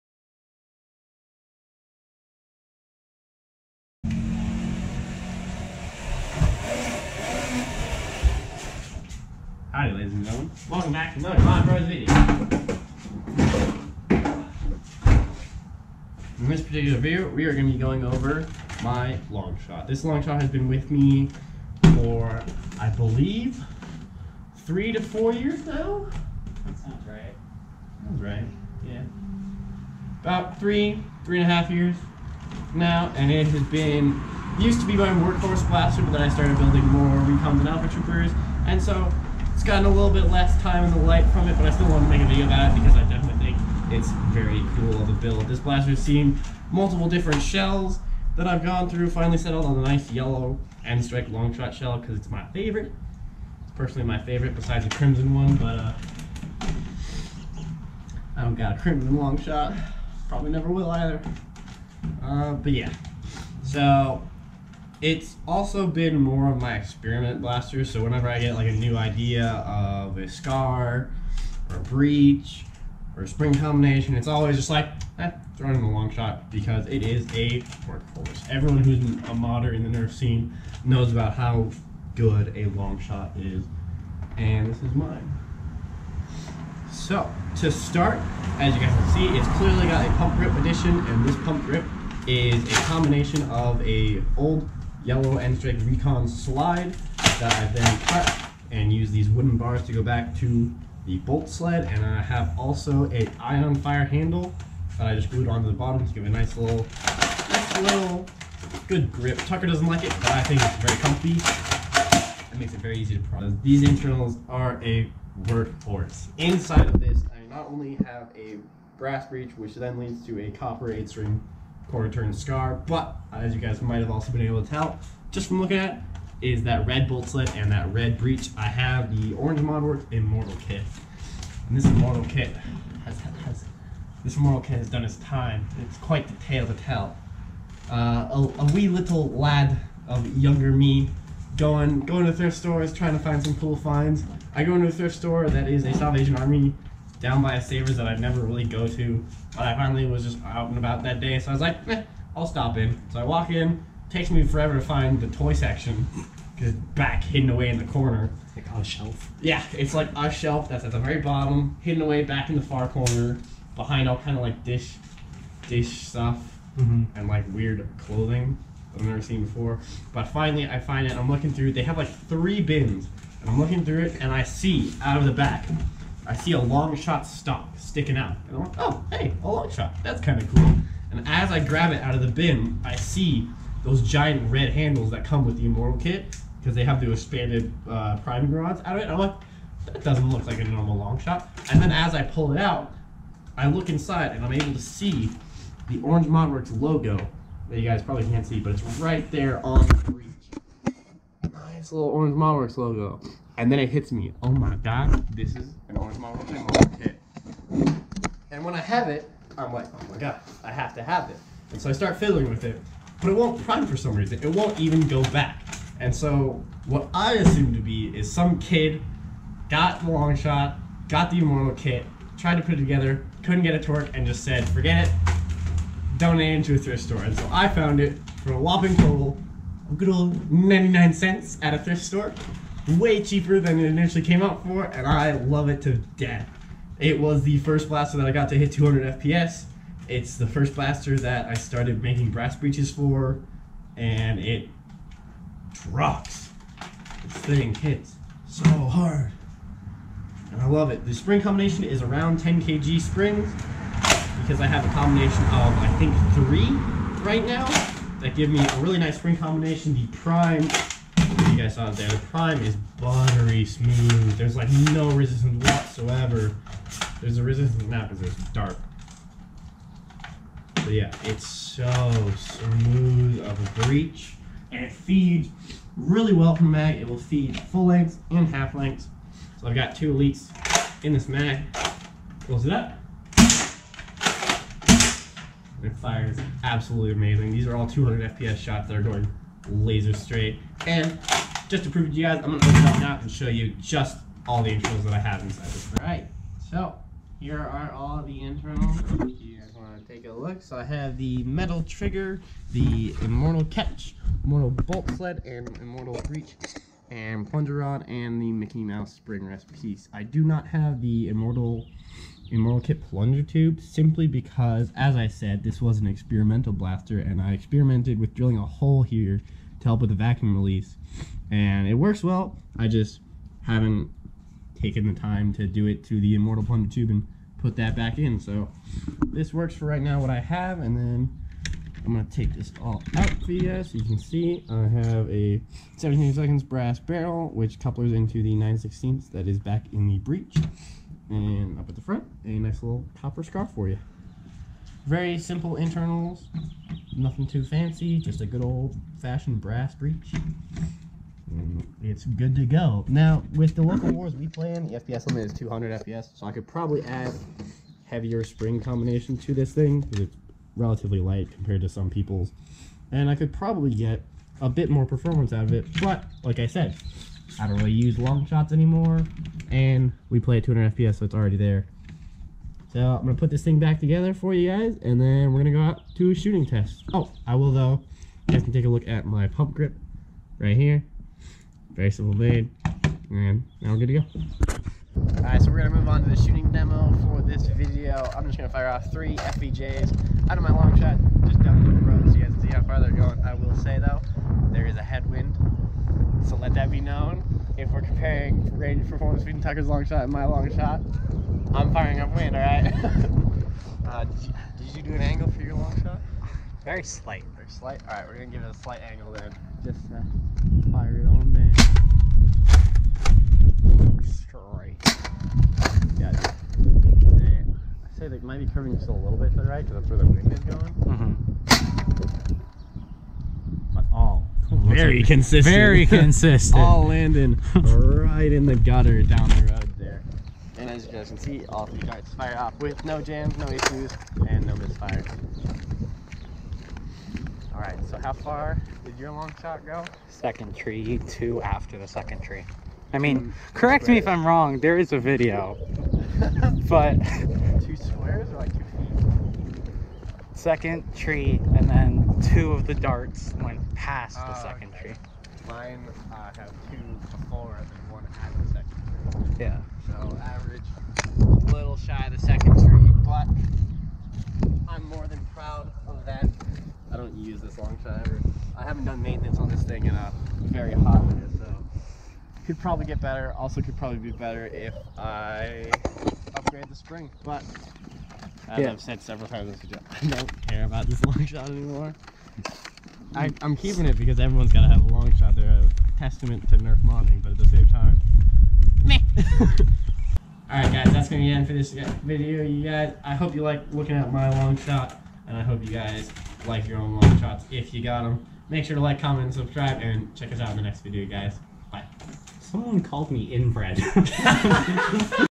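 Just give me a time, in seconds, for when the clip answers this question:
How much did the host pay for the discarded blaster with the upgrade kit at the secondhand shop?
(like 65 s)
230 s.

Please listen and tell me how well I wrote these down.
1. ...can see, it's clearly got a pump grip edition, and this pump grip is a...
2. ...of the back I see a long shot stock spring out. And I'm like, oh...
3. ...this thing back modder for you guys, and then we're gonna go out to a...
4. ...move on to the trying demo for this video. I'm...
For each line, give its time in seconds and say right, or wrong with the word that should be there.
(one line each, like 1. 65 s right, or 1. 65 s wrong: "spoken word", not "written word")
1. 88 s right
2. 175 s wrong: "sticking", not "spring"
3. 373 s wrong: "together", not "modder"
4. 385 s wrong: "shooting", not "trying".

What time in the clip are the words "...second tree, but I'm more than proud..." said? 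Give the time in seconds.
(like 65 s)
462 s.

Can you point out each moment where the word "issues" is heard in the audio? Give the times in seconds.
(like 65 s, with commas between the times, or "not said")
433 s.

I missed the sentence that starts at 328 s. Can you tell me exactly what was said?
So this works for right now what I have.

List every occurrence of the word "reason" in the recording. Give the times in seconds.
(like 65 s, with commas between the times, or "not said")
214 s.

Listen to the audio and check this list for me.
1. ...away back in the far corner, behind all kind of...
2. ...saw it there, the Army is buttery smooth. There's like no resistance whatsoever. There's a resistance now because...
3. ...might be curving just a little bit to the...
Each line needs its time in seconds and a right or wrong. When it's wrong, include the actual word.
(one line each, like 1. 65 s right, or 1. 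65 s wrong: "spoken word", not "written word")
1. 162 s right
2. 261 s wrong: "Prime", not "Army"
3. 418 s right.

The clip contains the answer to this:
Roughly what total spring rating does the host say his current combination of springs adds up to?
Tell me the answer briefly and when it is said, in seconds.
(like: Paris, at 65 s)
10 kg, at 252 s.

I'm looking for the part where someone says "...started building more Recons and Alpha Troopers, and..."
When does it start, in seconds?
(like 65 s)
36 s.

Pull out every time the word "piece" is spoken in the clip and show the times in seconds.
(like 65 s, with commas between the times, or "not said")
309 s.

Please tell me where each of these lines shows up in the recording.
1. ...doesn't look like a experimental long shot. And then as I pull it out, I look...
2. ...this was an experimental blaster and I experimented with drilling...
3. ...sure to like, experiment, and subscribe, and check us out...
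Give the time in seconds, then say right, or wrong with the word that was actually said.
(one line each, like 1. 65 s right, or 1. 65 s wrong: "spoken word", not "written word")
1. 190 s wrong: "normal", not "experimental"
2. 315 s right
3. 498 s wrong: "comment", not "experiment".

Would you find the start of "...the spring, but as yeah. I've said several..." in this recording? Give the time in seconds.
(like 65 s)
476 s.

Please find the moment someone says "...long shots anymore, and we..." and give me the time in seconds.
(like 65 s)
368 s.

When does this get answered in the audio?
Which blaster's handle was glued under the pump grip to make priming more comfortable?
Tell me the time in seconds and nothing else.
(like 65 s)
103 s.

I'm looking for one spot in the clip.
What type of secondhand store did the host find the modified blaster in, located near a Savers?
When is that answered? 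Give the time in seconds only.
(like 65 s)
145 s.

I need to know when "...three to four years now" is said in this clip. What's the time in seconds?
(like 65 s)
24 s.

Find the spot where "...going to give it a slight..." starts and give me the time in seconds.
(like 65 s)
408 s.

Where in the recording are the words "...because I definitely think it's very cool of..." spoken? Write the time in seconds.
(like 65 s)
42 s.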